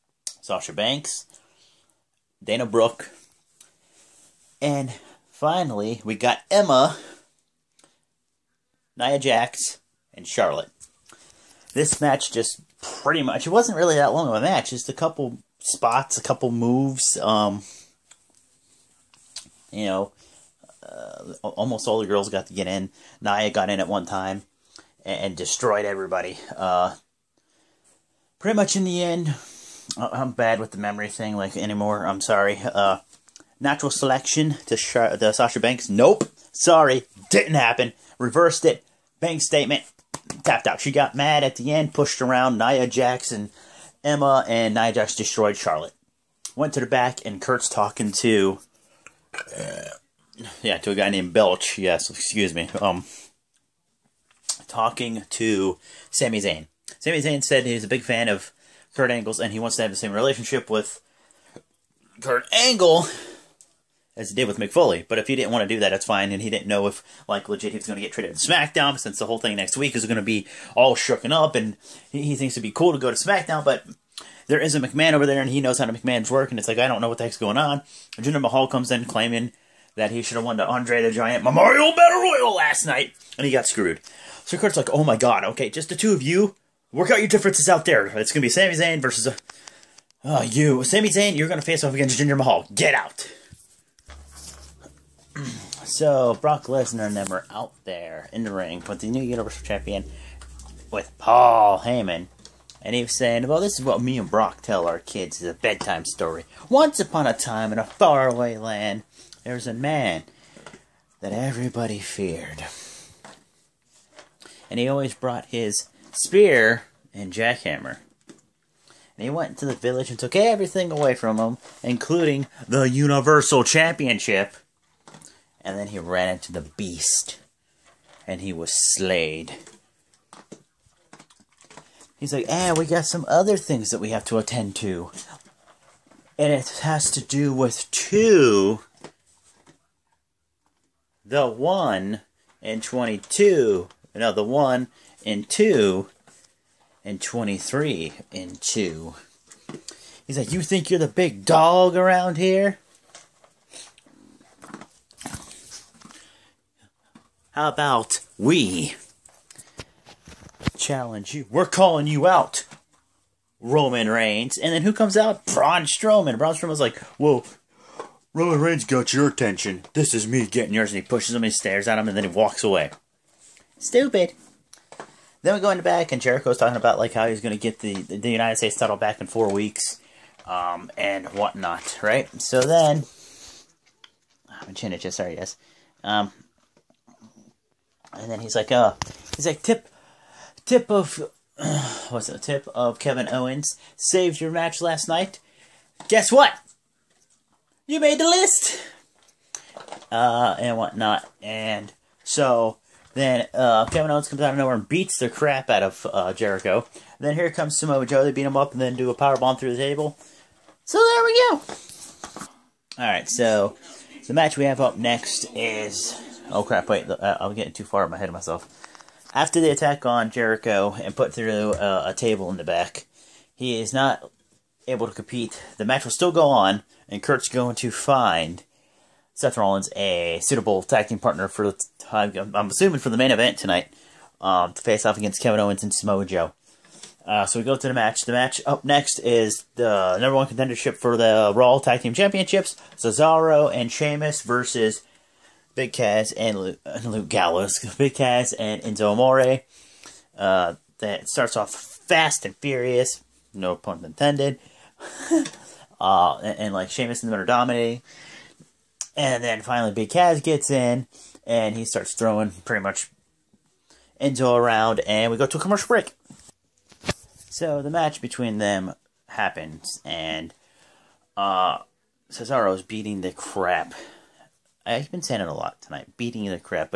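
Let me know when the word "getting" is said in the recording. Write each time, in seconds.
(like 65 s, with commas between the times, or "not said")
170 s, 217 s.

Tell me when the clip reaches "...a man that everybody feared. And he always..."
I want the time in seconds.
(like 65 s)
109 s.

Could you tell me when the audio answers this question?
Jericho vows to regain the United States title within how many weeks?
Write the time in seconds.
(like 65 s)
179 s.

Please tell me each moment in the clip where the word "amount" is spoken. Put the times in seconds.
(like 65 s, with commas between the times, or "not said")
not said.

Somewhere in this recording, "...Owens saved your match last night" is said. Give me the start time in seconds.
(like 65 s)
193 s.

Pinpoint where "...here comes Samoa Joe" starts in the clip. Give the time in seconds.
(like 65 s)
207 s.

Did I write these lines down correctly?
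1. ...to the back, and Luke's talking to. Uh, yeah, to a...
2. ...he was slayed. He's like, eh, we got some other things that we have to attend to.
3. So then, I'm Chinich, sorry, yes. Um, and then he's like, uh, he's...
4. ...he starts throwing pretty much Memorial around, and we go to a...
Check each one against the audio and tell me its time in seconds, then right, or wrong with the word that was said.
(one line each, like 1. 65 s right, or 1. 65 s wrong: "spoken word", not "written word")
1. 46 s wrong: "Kurt", not "Luke"
2. 128 s right
3. 182 s right
4. 261 s wrong: "Enzo", not "Memorial".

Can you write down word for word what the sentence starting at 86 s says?
Work out your differences out there.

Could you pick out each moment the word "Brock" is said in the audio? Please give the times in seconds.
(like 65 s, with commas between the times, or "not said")
96 s, 104 s.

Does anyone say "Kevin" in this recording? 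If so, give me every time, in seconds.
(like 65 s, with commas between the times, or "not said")
192 s, 203 s, 235 s.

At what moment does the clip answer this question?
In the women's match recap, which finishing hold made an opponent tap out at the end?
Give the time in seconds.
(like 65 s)
39 s.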